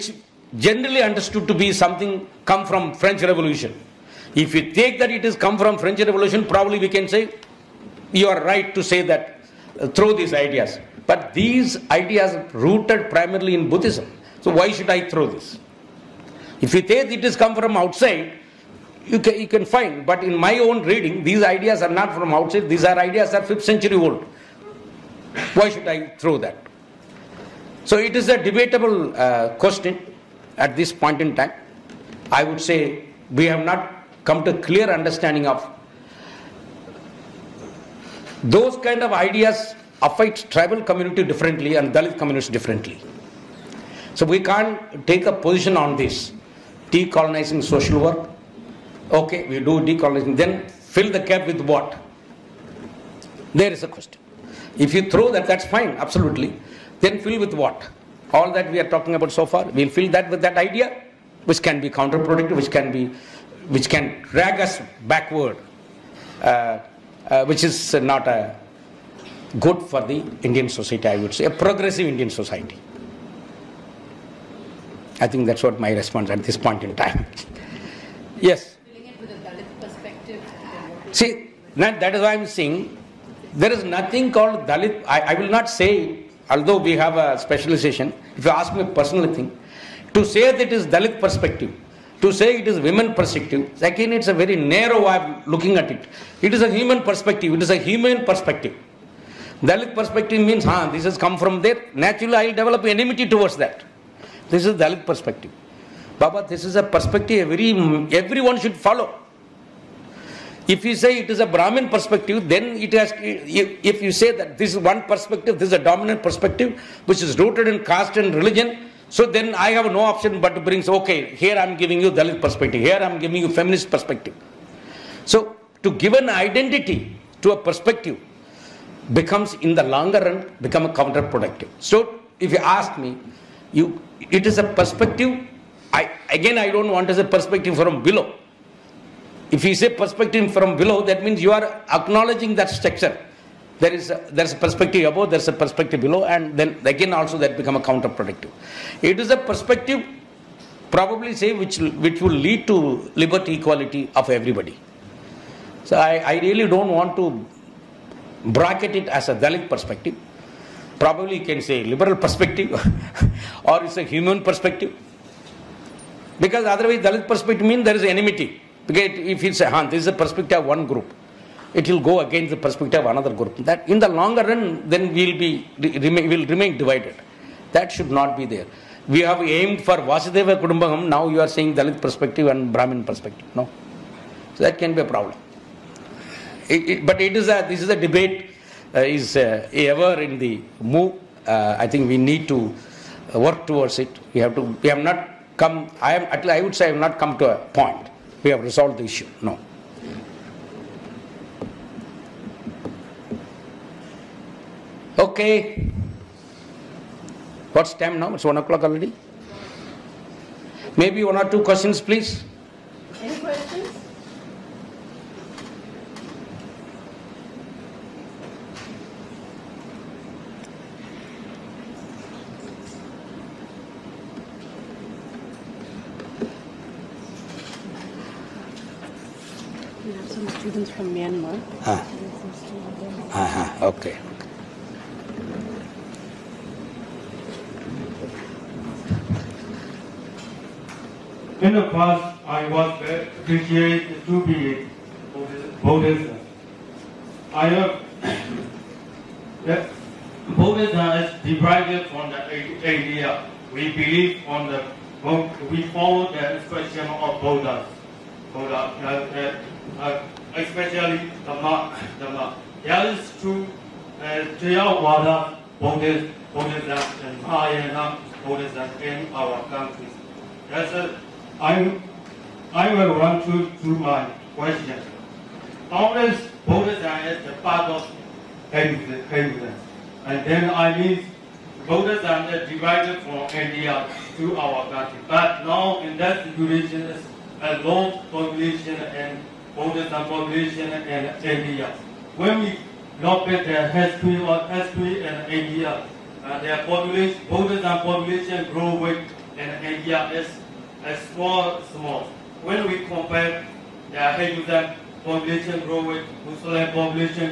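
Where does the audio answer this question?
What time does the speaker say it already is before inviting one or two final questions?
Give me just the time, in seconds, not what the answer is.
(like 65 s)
208 s.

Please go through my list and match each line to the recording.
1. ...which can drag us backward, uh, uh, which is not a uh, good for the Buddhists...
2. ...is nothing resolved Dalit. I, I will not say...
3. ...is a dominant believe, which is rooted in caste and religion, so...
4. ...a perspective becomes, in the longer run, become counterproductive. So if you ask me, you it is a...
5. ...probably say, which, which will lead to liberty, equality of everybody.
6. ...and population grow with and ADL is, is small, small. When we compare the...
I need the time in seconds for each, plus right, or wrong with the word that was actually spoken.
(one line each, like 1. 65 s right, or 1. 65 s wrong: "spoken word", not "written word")
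1. 63 s wrong: "Indian", not "Buddhists"
2. 83 s wrong: "called", not "resolved"
3. 115 s wrong: "perspective", not "believe"
4. 127 s right
5. 150 s right
6. 297 s right.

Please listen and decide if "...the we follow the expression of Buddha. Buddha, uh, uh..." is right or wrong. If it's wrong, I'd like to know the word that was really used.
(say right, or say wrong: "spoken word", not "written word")
right.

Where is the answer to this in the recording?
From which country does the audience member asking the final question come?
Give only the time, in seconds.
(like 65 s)
231 s.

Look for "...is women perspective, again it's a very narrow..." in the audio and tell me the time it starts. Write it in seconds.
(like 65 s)
92 s.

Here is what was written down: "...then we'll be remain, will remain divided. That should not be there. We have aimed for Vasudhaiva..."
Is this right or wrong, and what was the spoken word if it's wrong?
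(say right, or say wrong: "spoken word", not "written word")
right.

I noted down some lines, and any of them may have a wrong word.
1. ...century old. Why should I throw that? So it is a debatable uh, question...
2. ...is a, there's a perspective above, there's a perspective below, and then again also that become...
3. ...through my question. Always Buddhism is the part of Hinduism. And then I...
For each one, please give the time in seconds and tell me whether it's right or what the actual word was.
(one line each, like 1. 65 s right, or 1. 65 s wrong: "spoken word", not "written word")
1. 23 s right
2. 143 s right
3. 273 s right.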